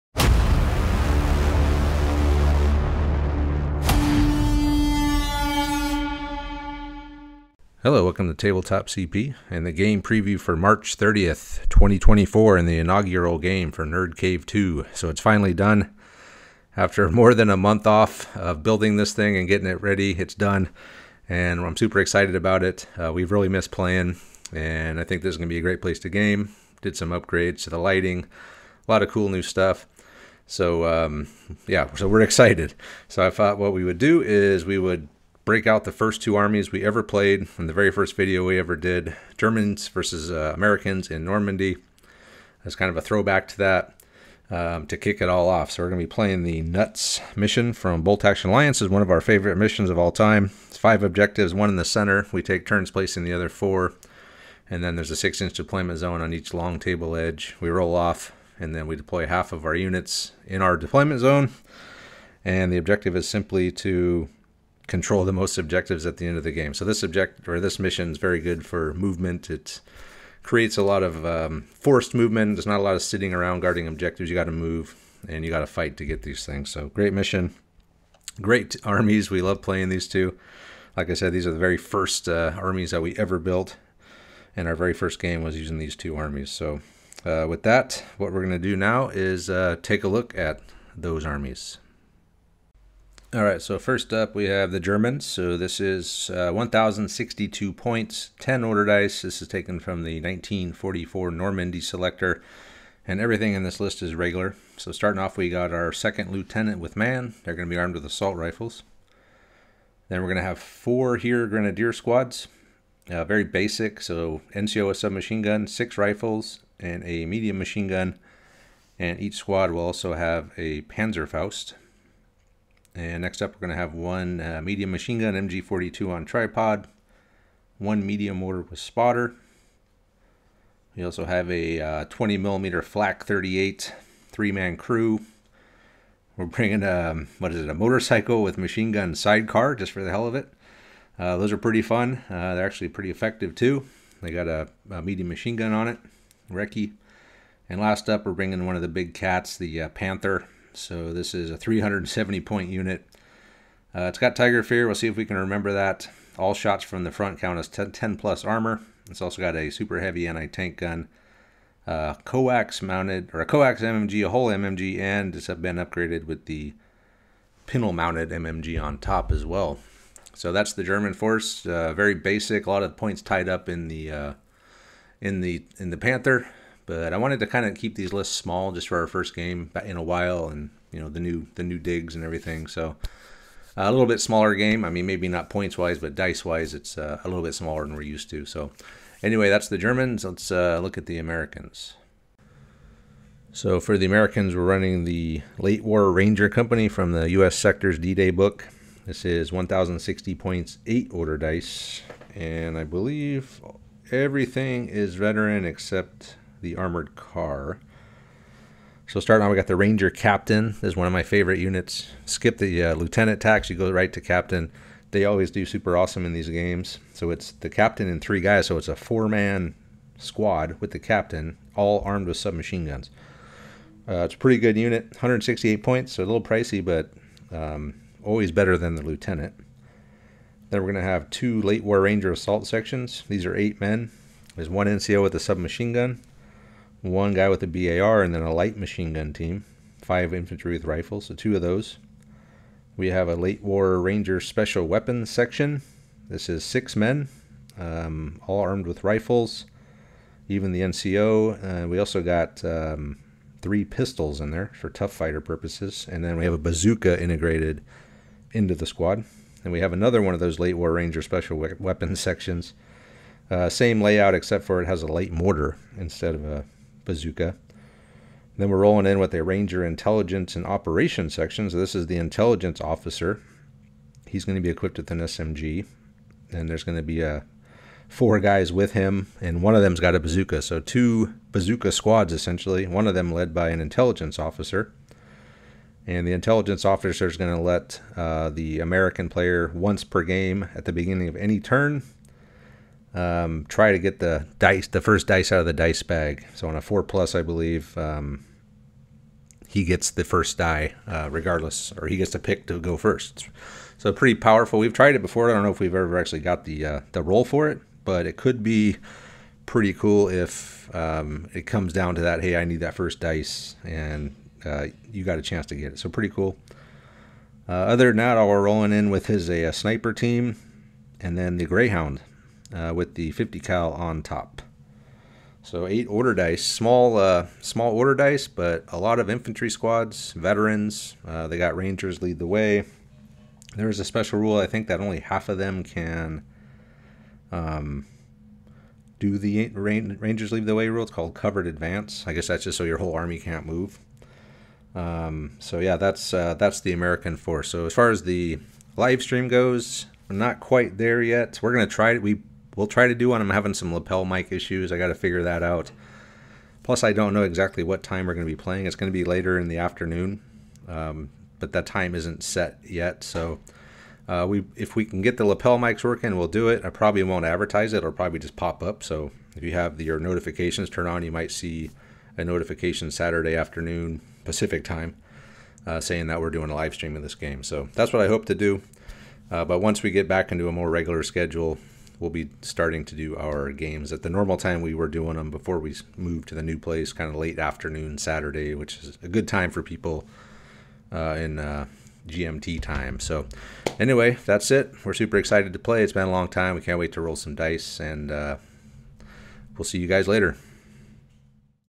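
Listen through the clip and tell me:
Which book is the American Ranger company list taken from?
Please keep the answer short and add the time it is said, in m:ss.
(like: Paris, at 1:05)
U.S. Sector's D-Day, at 3:17.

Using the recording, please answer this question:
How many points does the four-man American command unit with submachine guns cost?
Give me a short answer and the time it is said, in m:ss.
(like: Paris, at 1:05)
168, at 3:45.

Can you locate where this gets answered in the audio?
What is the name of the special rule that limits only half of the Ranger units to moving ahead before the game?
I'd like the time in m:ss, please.
5:41.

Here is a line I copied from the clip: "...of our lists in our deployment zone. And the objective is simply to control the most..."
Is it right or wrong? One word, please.
wrong.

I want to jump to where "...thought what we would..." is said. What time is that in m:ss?
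0:33.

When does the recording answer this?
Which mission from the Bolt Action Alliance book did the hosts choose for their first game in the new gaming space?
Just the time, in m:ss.
0:46.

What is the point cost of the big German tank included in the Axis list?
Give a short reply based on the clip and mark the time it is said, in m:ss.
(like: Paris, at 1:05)
370, at 2:31.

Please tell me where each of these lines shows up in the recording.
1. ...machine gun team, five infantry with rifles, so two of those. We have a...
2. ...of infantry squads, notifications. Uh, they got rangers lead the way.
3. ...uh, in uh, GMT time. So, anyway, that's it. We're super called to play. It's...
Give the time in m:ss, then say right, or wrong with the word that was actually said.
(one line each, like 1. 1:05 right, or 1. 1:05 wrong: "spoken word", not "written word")
1. 3:58 right
2. 5:29 wrong: "veterans", not "notifications"
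3. 6:31 wrong: "excited", not "called".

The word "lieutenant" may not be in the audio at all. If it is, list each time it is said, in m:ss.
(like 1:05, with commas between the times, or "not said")
1:46, 3:32, 3:49.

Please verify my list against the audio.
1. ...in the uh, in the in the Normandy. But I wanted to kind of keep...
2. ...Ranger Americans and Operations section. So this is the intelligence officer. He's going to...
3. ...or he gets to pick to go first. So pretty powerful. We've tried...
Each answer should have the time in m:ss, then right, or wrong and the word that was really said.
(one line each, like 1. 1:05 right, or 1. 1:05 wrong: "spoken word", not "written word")
1. 2:53 wrong: "Panther", not "Normandy"
2. 4:29 wrong: "Intelligence", not "Americans"
3. 5:01 right.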